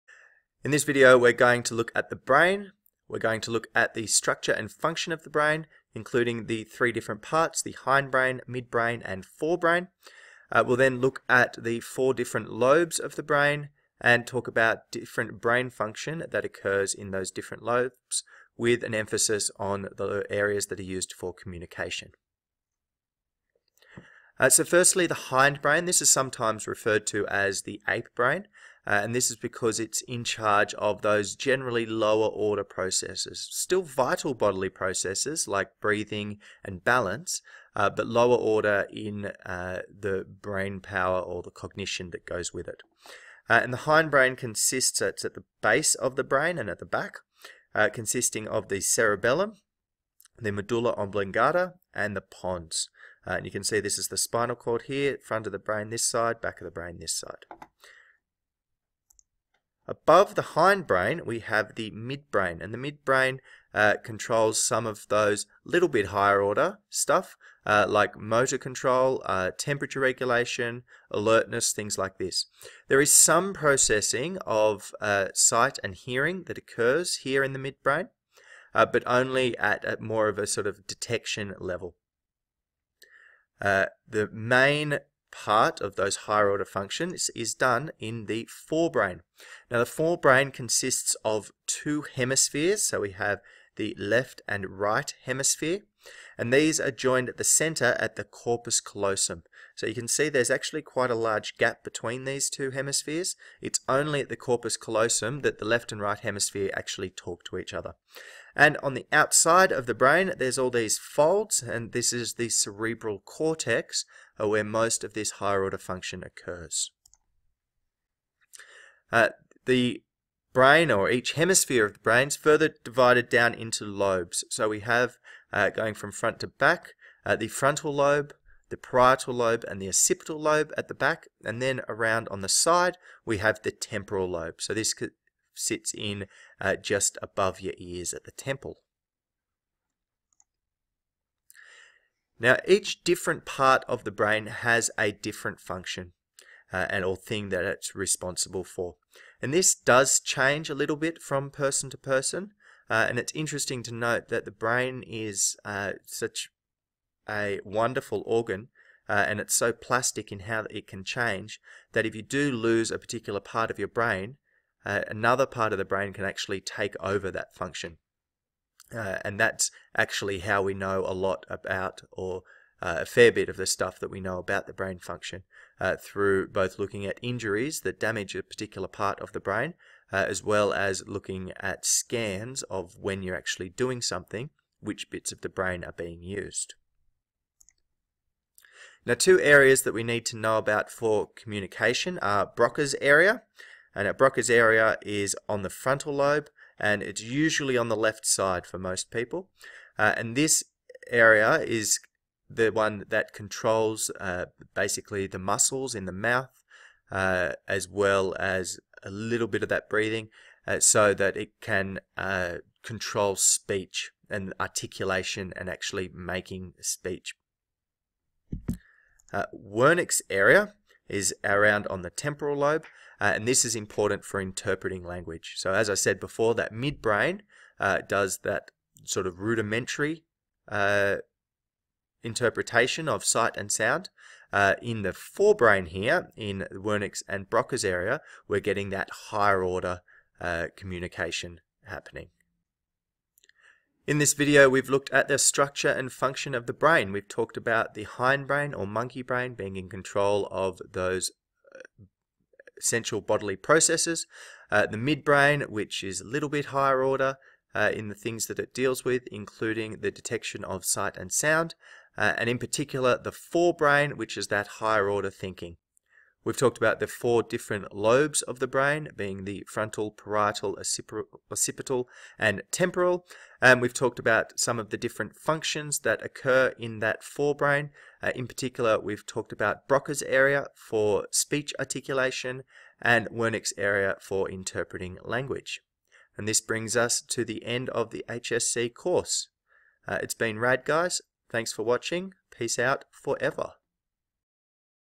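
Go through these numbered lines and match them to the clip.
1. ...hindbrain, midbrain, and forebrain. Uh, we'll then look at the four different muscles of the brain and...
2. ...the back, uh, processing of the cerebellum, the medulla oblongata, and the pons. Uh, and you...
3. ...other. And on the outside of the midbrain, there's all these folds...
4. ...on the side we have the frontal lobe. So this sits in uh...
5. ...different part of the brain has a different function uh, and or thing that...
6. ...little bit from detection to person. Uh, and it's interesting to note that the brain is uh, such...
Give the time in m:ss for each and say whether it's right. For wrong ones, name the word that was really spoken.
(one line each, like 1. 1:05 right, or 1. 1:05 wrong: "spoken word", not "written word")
1. 0:07 wrong: "lobes", not "muscles"
2. 0:46 wrong: "consisting", not "processing"
3. 1:47 wrong: "brain", not "midbrain"
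4. 2:12 wrong: "temporal", not "frontal"
5. 2:23 right
6. 2:30 wrong: "person", not "detection".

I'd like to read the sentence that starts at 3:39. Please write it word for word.
Uh, Wernicke's area is around on the temporal lobe uh, and this is important for interpreting language.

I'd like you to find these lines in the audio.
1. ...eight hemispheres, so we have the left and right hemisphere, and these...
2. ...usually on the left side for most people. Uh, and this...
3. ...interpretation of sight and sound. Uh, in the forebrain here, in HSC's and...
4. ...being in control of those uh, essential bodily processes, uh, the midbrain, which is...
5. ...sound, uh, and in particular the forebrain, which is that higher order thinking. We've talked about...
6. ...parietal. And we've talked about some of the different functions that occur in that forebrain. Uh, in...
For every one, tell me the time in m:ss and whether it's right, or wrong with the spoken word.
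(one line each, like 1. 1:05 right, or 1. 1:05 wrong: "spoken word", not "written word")
1. 1:31 wrong: "two", not "eight"
2. 3:17 right
3. 3:52 wrong: "Wernicke", not "HSC"
4. 4:09 right
5. 4:21 right
6. 4:32 wrong: "temporal", not "parietal".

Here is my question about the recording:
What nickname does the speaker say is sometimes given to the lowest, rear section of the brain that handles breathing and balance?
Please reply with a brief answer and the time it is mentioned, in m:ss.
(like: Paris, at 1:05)
ape brain, at 0:27.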